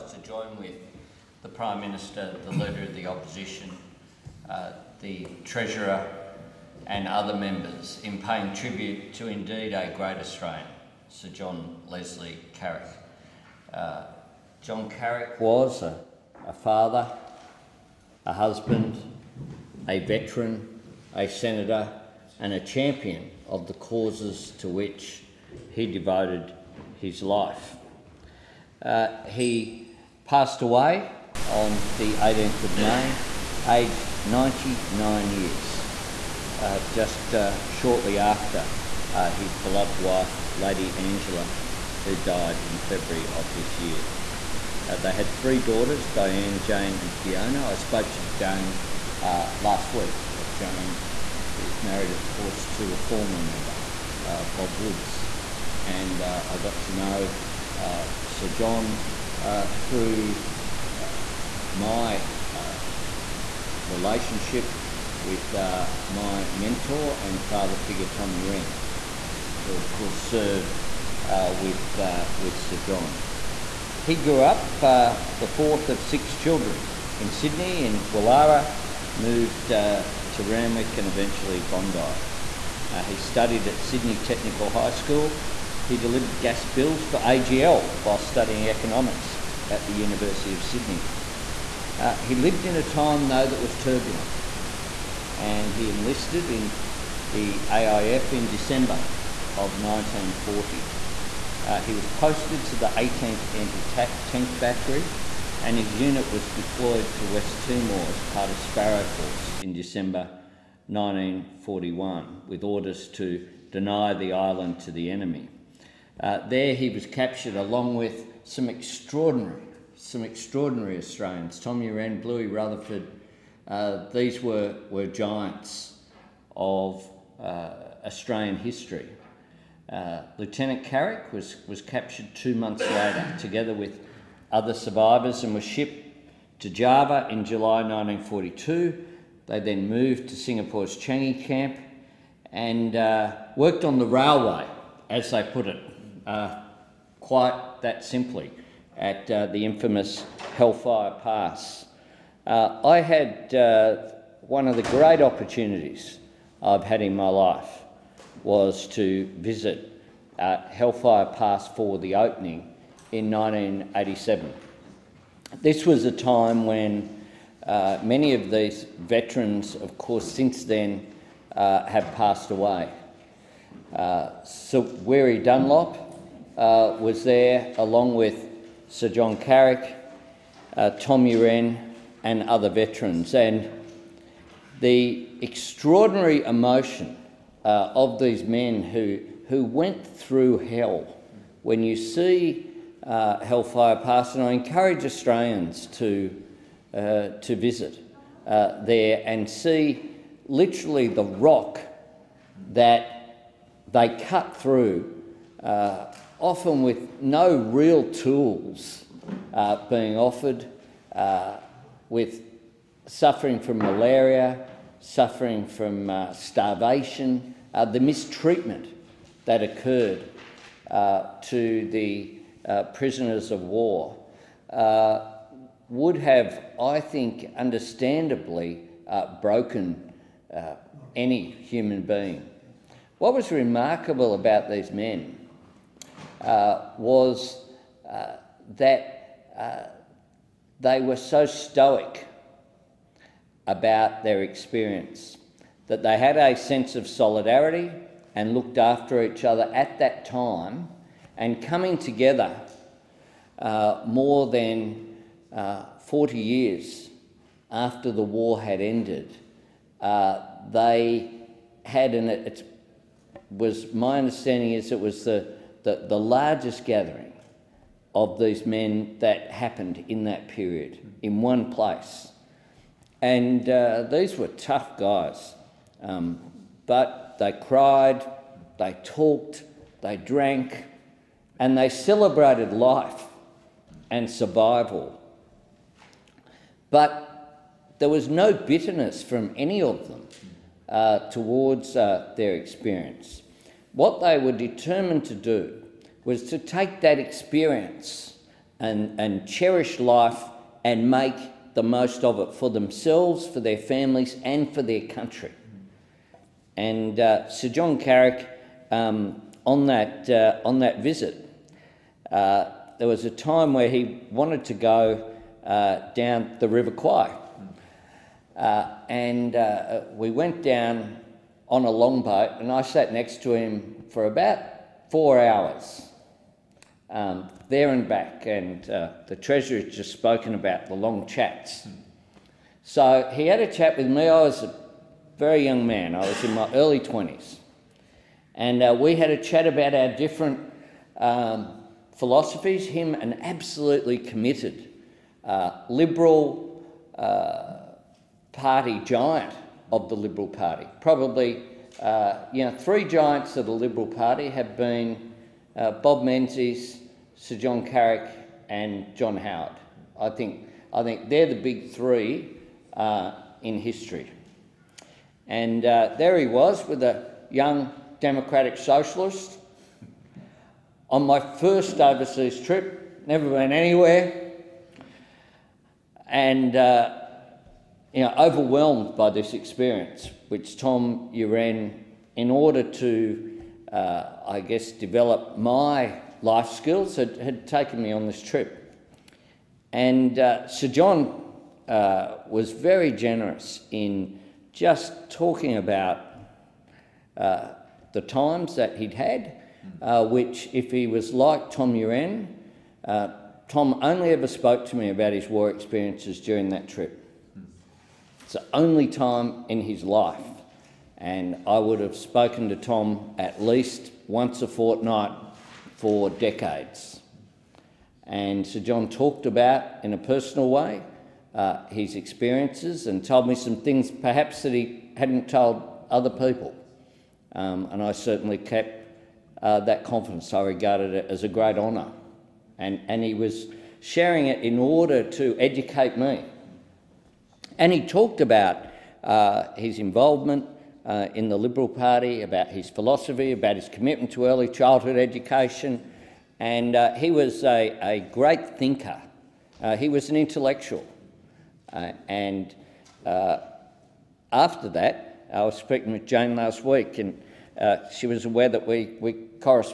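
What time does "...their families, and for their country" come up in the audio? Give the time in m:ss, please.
5:03.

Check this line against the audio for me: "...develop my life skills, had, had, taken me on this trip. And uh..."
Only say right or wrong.
right.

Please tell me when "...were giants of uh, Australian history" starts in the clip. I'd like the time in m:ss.
2:04.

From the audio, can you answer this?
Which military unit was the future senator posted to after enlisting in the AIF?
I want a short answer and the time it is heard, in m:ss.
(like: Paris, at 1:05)
18th Anti Tank Battery, at 1:42.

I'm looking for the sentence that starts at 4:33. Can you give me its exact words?
And uh, these were tough guys, um, but they cried, they talked, they drank, and they celebrated life and survival.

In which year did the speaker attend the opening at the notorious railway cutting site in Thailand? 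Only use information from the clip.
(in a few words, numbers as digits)
1987.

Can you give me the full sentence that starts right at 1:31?
Uh, he lived in a time, though, that was turbulent, and he enlisted in the AIF in December of 1940.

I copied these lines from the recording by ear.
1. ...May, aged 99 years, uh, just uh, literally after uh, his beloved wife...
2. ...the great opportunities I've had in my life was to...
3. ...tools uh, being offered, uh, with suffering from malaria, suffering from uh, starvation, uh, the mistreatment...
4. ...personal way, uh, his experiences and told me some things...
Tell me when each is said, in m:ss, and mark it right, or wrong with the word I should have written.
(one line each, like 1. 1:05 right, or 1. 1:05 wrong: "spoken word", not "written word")
1. 0:32 wrong: "shortly", not "literally"
2. 2:34 right
3. 3:28 right
4. 7:00 right.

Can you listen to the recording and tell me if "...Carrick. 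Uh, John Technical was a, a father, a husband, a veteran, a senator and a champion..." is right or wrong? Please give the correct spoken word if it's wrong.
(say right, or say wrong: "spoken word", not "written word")
wrong: "Carrick", not "Technical".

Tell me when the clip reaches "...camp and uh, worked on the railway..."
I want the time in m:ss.
2:21.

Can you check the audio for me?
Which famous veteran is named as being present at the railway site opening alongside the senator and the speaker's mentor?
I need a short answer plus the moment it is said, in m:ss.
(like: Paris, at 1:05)
Weary Dunlop, at 2:54.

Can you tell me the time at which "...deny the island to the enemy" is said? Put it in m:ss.
1:53.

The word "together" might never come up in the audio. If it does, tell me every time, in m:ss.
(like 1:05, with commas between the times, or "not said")
2:13, 4:11.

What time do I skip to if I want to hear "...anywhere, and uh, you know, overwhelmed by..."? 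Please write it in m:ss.
6:13.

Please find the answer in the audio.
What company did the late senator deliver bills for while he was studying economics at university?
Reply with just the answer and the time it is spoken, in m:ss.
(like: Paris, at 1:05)
AGL, at 1:27.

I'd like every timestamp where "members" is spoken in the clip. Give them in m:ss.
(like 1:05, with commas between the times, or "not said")
0:07, 0:53.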